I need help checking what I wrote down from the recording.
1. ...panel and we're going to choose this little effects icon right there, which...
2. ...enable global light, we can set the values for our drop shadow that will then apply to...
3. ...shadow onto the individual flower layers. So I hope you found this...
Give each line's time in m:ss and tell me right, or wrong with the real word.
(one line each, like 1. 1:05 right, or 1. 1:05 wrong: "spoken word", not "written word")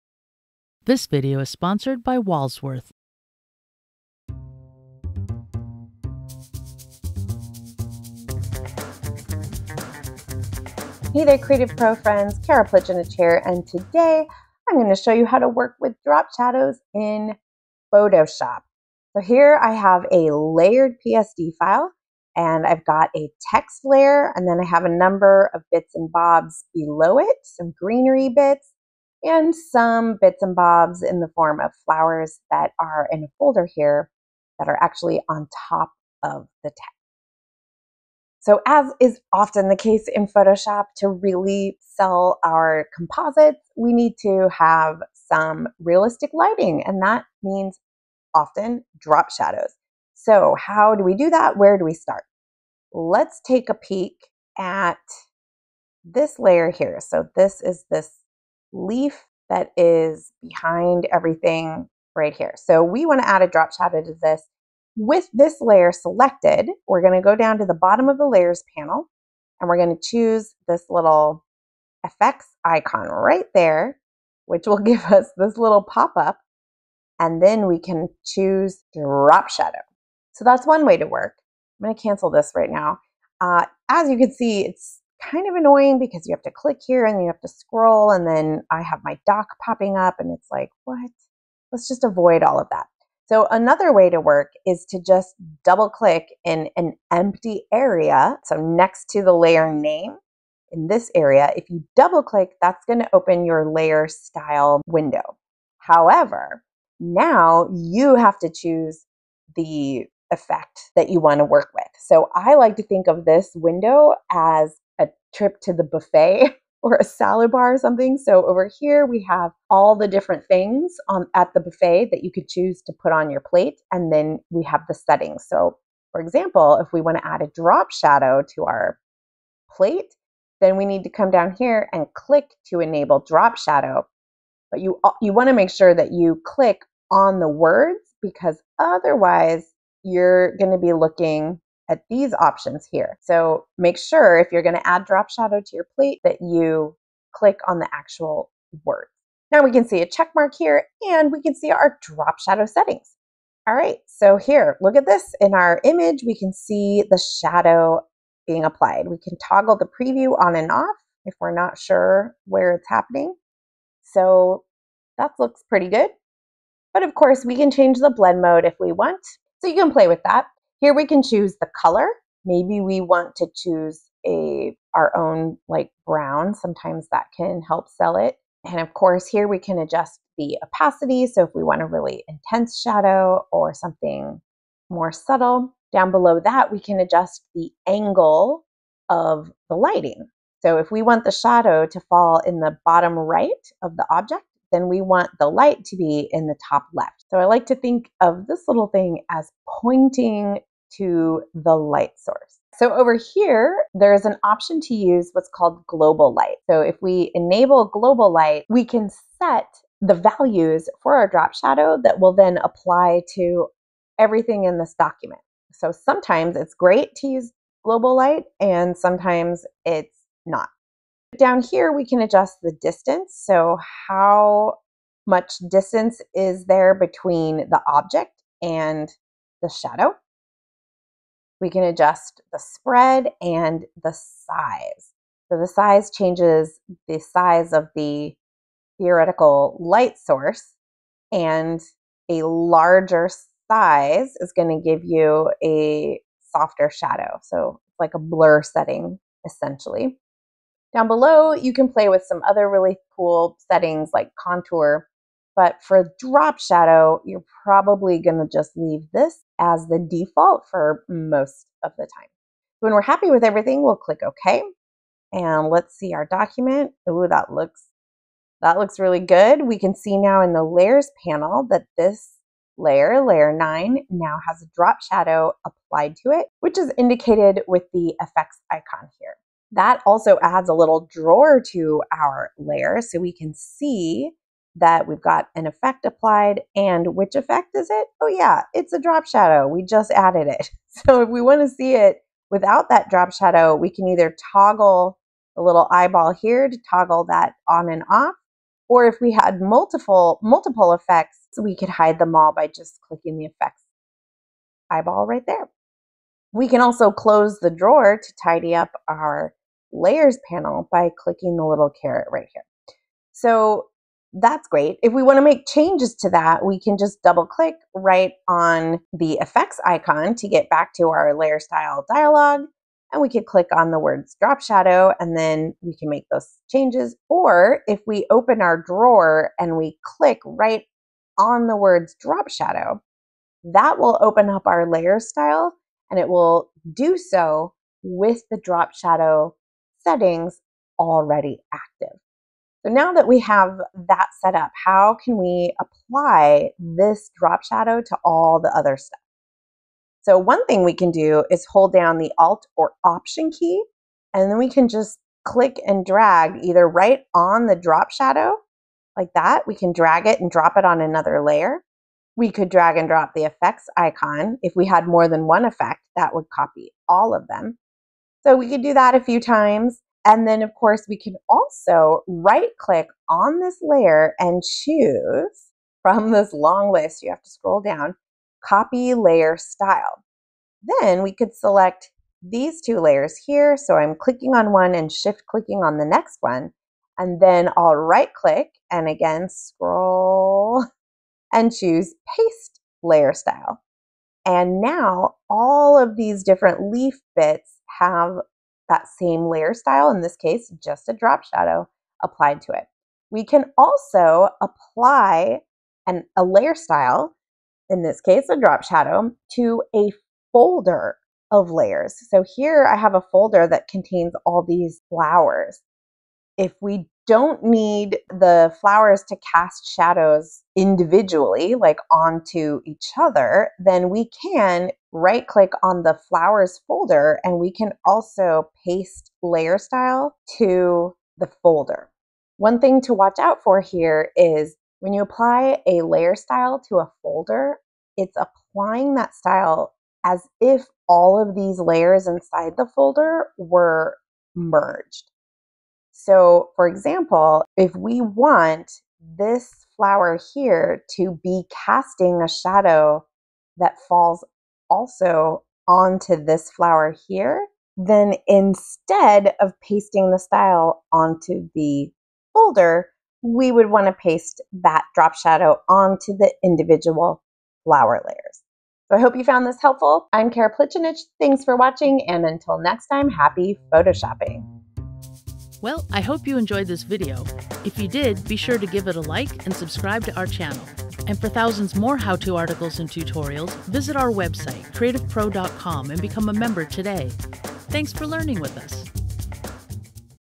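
1. 1:08 right
2. 3:27 right
3. 7:45 right.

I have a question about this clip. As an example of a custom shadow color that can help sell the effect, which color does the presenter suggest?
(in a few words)
Brown.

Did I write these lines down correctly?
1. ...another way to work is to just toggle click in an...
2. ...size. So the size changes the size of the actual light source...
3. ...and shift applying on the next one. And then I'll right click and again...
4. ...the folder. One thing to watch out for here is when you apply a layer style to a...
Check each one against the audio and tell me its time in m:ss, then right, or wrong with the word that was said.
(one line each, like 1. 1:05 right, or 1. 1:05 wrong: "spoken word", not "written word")
1. 1:33 wrong: "double", not "toggle"
2. 3:54 wrong: "theoretical", not "actual"
3. 6:24 wrong: "clicking", not "applying"
4. 7:11 right.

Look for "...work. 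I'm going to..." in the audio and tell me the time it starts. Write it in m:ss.
1:21.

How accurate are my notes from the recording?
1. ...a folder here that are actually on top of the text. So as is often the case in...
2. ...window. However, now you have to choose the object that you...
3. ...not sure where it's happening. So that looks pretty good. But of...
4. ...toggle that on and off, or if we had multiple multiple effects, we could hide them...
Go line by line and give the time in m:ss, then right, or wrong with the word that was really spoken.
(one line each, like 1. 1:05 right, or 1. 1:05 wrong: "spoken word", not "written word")
1. 0:33 right
2. 1:44 wrong: "effect", not "object"
3. 2:41 right
4. 4:56 right.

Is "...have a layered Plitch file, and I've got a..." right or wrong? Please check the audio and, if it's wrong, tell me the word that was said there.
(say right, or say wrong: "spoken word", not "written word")
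wrong: "PSD", not "Plitch".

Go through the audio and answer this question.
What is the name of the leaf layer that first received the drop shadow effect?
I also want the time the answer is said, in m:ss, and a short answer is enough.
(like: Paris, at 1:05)
Layer nine, at 4:33.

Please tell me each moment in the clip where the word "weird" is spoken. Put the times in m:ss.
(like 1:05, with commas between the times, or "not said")
not said.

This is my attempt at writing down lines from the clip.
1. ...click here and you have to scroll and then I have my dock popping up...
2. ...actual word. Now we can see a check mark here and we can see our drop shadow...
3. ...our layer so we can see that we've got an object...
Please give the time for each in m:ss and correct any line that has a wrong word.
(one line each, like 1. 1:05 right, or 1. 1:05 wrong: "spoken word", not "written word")
1. 1:26 right
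2. 2:27 right
3. 4:42 wrong: "effect", not "object".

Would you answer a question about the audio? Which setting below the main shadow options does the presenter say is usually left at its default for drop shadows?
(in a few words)
Contour.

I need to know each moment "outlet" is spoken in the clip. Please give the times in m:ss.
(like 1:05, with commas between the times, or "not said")
not said.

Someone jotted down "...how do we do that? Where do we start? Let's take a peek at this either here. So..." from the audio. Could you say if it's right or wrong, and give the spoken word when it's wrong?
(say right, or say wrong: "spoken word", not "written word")
wrong: "layer", not "either".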